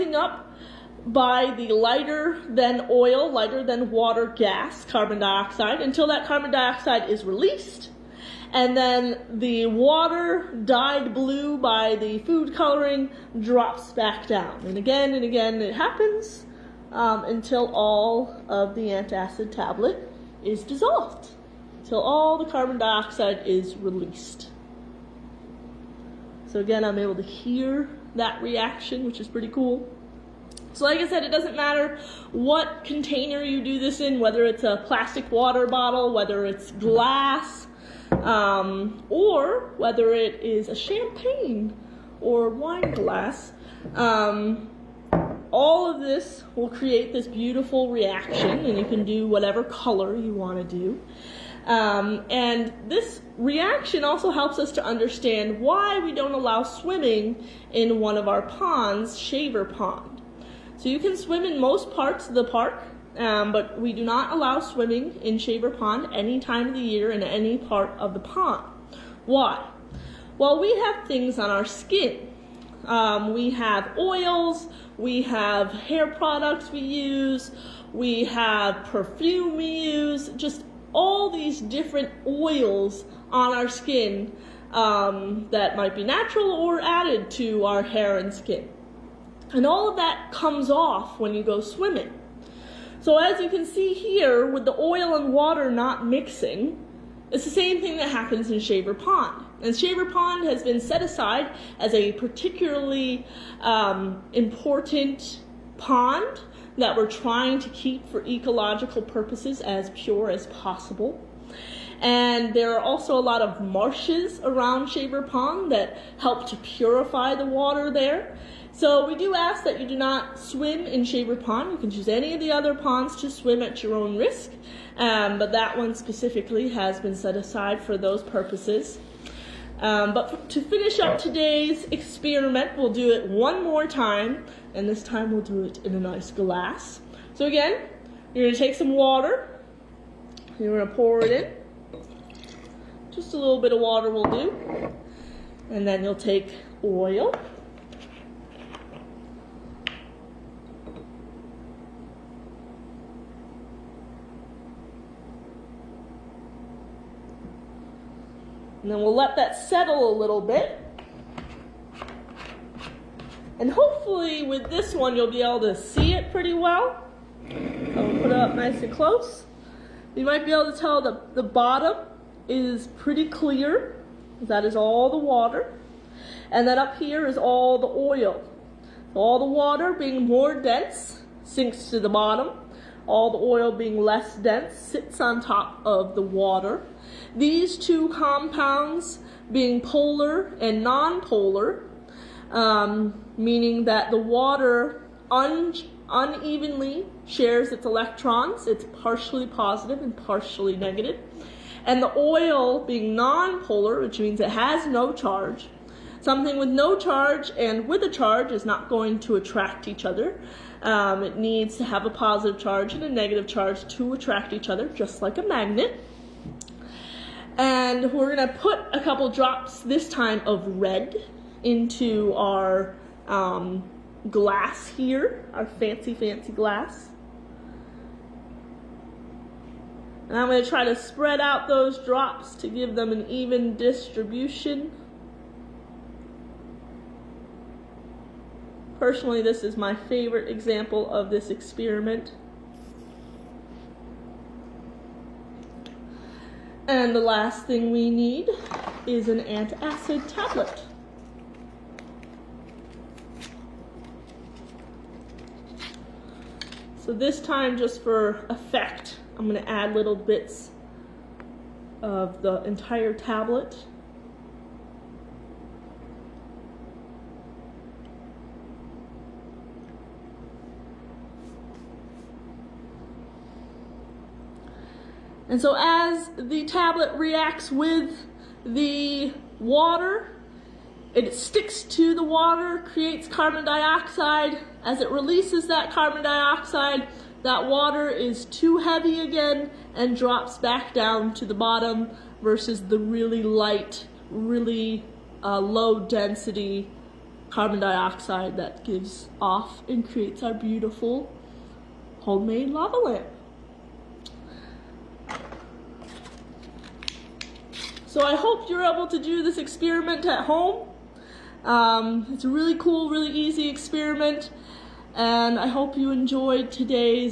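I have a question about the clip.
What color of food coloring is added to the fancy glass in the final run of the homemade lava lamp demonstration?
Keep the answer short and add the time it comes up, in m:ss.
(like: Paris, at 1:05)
Red, at 3:40.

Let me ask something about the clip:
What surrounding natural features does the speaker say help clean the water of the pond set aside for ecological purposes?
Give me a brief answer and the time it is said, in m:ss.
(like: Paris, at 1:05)
Marshes, at 1:53.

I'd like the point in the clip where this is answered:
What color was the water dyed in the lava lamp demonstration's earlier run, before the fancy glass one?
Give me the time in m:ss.
0:11.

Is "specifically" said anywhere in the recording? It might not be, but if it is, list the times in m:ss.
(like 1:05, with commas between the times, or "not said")
2:05.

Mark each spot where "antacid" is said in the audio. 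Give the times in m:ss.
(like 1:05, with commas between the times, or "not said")
0:18, 4:09.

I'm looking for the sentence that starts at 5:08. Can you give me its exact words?
So I hope you're able to do this experiment at home.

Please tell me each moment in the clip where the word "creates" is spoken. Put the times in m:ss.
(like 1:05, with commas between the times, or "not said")
0:46, 4:42, 5:00.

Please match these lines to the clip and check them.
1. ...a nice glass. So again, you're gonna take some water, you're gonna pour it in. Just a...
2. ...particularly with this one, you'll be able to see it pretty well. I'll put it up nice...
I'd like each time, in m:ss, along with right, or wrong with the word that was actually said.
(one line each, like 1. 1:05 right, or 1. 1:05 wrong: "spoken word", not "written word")
1. 2:15 right
2. 2:43 wrong: "hopefully", not "particularly".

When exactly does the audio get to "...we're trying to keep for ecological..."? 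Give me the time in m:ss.
1:46.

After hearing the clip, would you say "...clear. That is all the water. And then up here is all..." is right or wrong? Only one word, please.
right.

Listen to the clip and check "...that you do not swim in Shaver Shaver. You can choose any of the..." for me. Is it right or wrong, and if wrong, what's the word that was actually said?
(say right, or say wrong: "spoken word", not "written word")
wrong: "Pond", not "Shaver".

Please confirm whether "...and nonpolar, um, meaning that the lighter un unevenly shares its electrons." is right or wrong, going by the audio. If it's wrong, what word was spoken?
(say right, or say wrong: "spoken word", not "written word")
wrong: "water", not "lighter".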